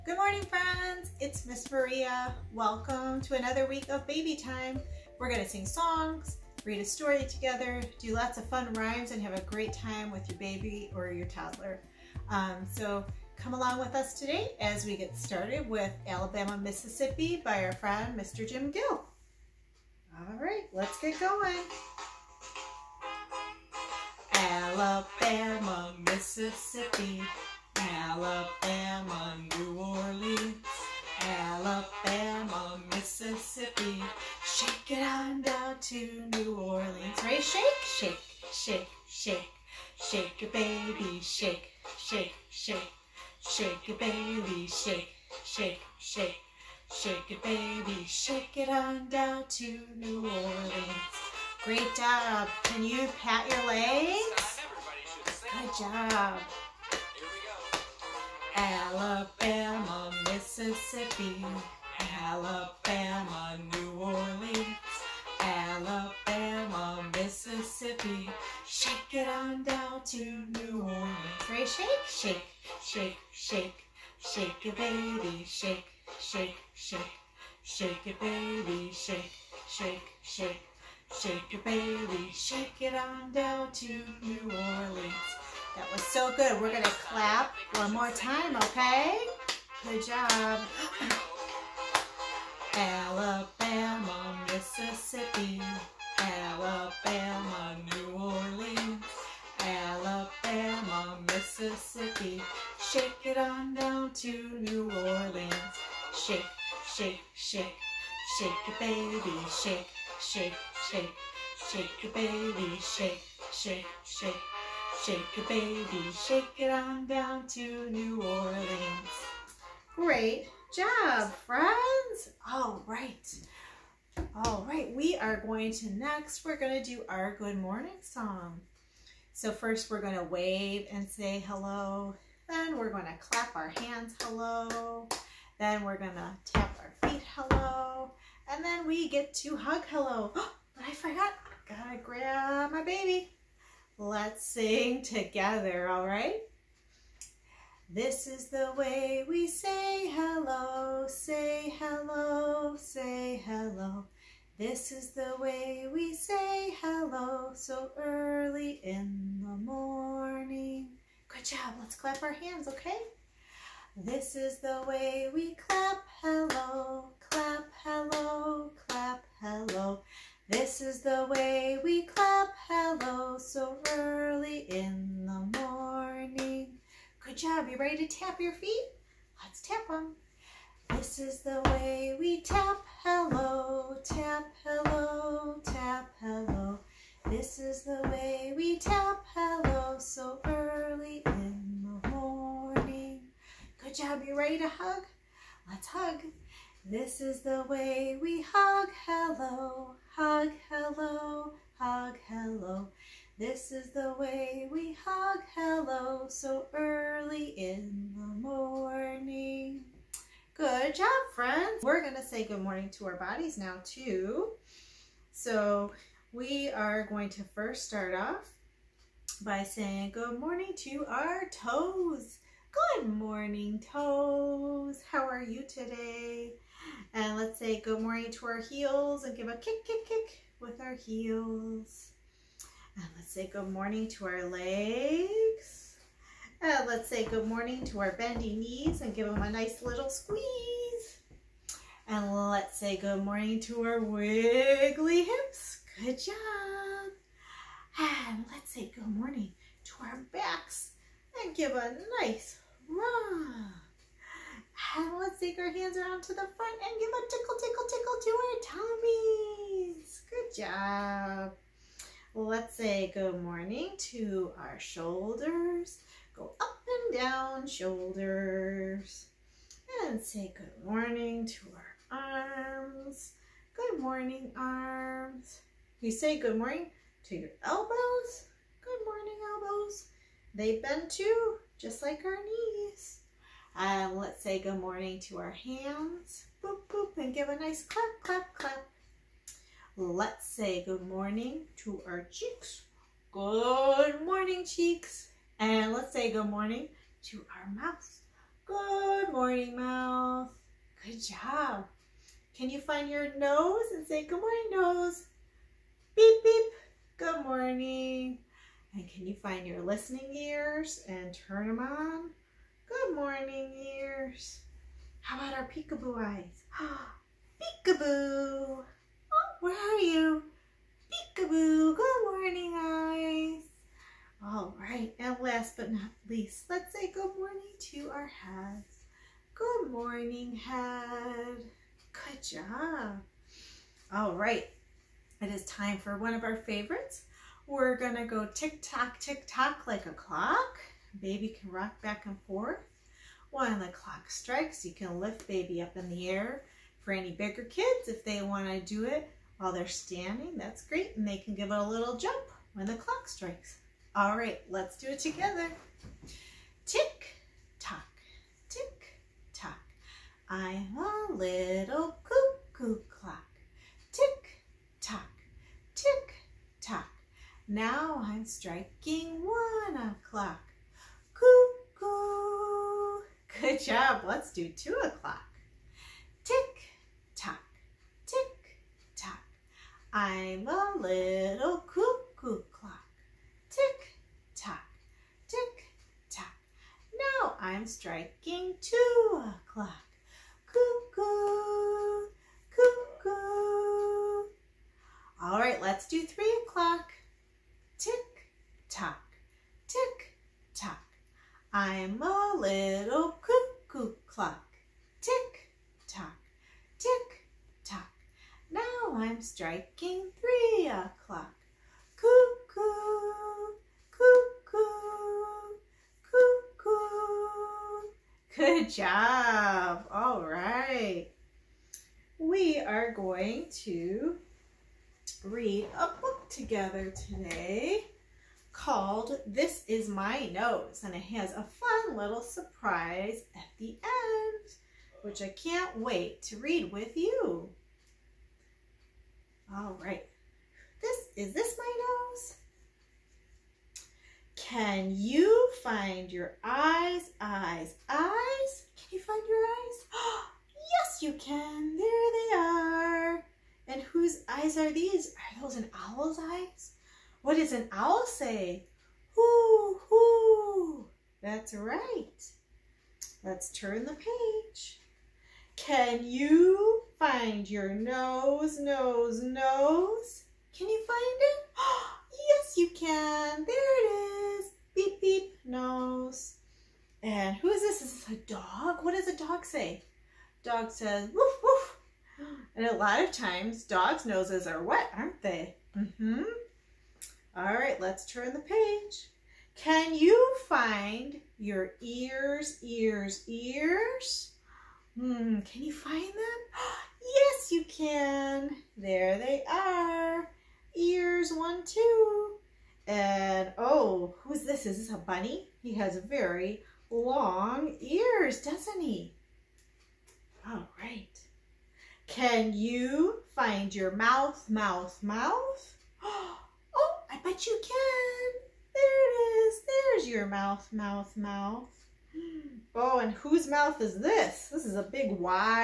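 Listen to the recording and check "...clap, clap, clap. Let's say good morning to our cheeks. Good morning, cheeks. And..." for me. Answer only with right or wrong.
right.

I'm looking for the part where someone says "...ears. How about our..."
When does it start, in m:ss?
5:13.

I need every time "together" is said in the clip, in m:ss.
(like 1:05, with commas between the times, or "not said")
0:07, 2:25, 5:55, 7:06.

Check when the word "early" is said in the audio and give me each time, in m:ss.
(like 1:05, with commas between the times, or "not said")
2:37, 2:53, 3:10, 3:26.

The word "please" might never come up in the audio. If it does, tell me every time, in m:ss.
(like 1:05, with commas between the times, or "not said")
not said.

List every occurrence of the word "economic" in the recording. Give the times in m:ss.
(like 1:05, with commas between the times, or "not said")
not said.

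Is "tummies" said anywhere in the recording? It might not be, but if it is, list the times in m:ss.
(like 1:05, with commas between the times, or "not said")
4:19.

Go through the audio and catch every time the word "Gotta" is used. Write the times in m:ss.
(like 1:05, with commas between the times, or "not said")
2:21.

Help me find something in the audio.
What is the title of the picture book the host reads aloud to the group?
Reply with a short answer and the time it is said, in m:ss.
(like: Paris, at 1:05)
This Is My Nose, at 7:09.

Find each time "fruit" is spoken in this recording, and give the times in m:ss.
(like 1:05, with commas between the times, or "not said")
not said.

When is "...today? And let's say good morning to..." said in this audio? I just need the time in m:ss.
3:45.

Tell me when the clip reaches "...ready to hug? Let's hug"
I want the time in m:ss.
3:14.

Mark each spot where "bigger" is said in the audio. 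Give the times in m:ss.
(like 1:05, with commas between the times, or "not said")
5:47.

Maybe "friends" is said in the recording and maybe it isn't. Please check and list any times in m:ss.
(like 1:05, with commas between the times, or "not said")
0:00, 0:17, 2:01, 3:31.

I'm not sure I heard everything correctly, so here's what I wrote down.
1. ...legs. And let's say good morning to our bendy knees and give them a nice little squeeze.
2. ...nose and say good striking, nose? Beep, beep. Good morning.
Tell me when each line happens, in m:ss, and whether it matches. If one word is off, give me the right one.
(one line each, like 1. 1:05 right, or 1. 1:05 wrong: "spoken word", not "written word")
1. 3:54 right
2. 5:03 wrong: "morning", not "striking".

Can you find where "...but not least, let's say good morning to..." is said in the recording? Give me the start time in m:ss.
5:25.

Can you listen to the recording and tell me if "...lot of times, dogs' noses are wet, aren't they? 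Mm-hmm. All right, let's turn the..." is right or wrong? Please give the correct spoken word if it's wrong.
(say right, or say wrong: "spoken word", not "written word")
right.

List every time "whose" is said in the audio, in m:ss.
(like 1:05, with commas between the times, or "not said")
7:34, 8:43.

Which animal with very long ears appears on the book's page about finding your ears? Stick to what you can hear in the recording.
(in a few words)
bunny.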